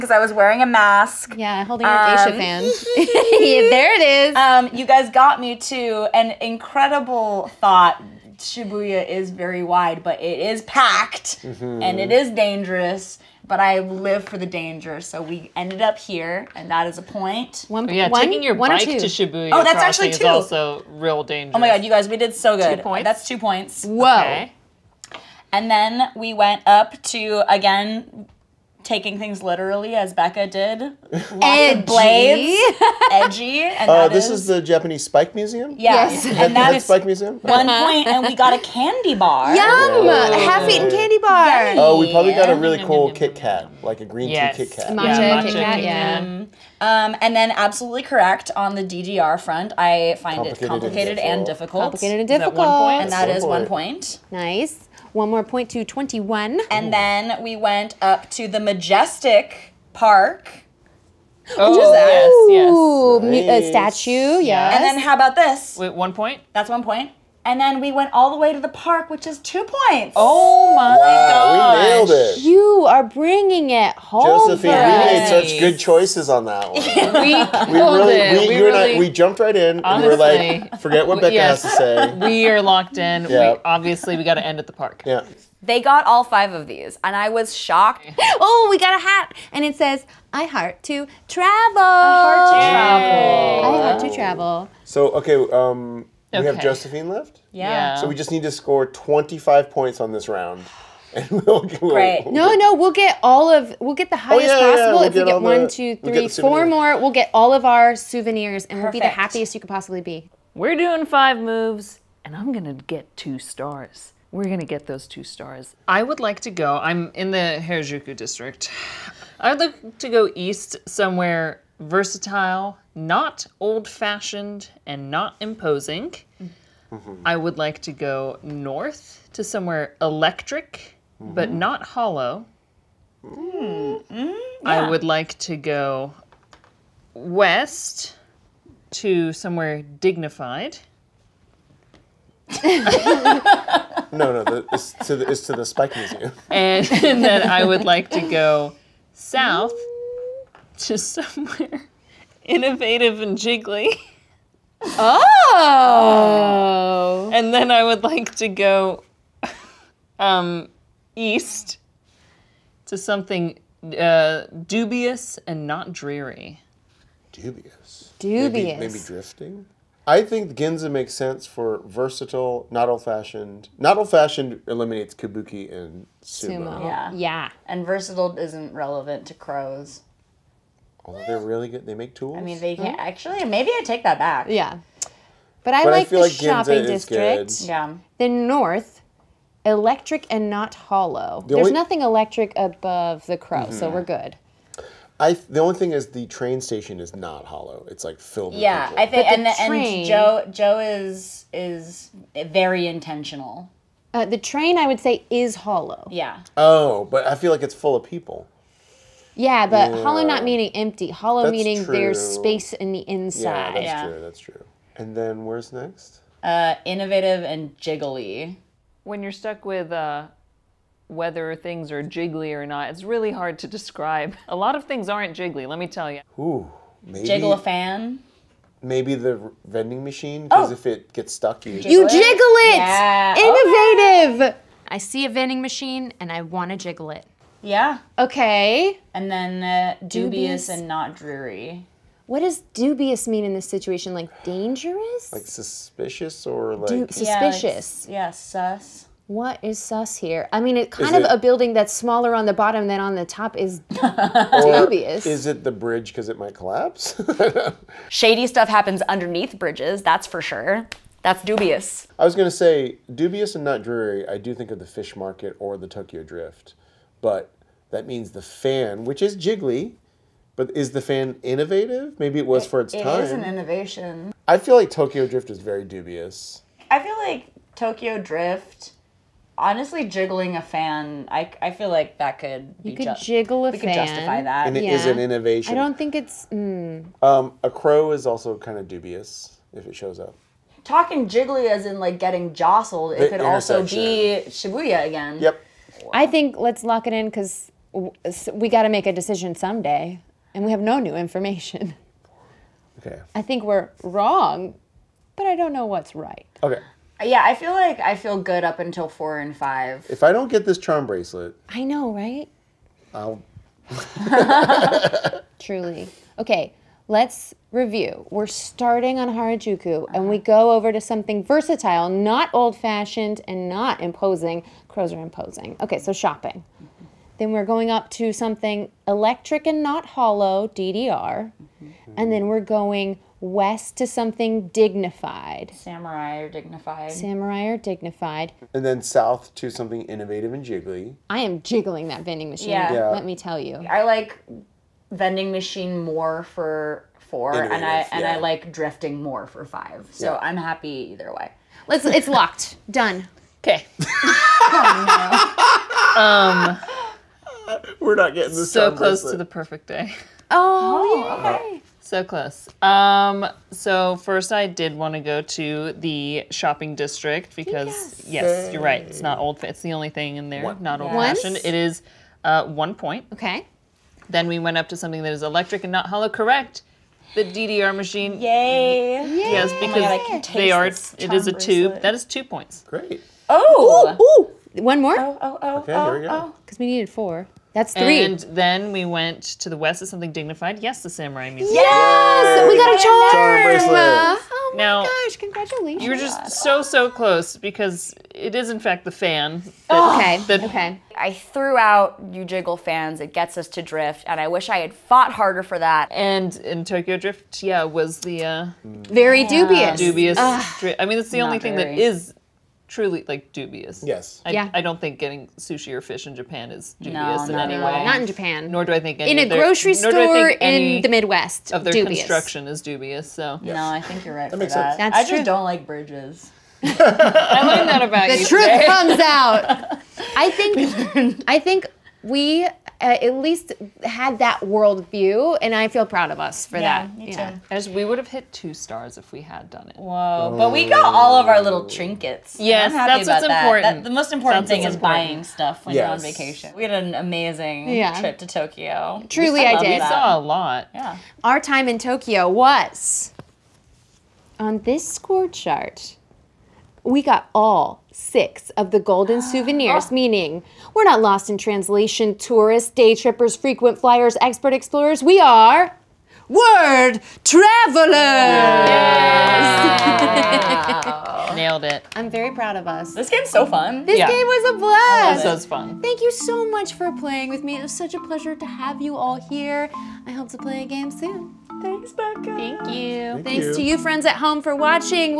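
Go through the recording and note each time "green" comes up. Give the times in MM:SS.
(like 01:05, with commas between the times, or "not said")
00:44.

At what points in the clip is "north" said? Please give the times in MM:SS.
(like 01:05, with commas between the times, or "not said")
02:08, 03:08.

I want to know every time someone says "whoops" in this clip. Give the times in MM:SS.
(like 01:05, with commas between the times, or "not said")
not said.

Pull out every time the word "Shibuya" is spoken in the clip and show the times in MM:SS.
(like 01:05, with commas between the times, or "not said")
00:08, 00:18, 04:54.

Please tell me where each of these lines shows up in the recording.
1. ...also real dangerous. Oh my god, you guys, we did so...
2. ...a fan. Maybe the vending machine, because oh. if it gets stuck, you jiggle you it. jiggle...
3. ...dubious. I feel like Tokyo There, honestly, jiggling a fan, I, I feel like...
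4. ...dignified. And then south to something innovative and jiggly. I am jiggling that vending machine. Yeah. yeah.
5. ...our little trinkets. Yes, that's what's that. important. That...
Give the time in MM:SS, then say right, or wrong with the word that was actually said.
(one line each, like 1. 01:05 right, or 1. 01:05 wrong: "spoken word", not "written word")
1. 00:20 right
2. 03:47 right
3. 04:35 wrong: "Drift", not "There"
4. 05:37 right
5. 07:21 right.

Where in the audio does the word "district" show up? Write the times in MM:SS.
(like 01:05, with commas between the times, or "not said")
01:58, 03:07, 06:06.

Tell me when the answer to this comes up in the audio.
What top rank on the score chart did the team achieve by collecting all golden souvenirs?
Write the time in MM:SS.
07:46.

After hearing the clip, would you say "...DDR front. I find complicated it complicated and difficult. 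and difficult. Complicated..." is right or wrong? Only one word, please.
right.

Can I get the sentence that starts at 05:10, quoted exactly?
If I don't get this charm bracelet, I know, right?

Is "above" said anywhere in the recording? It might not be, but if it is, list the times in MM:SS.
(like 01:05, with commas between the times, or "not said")
03:12.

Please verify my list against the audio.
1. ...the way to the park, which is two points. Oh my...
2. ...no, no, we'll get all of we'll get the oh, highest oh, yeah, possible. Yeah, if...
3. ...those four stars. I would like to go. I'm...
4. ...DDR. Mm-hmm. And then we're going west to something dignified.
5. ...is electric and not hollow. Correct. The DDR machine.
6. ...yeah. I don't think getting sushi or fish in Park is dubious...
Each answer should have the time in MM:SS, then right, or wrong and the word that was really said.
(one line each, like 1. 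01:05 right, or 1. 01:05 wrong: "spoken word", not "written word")
1. 01:08 right
2. 01:42 right
3. 01:54 wrong: "two", not "four"
4. 05:30 right
5. 06:15 right
6. 06:54 wrong: "Japan", not "Park".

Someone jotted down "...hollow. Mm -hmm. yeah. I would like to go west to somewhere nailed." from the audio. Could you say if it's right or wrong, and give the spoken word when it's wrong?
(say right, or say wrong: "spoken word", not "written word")
wrong: "dignified", not "nailed".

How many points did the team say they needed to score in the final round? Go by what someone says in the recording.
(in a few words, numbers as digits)
25.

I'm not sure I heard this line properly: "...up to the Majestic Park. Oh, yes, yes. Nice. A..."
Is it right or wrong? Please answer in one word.
right.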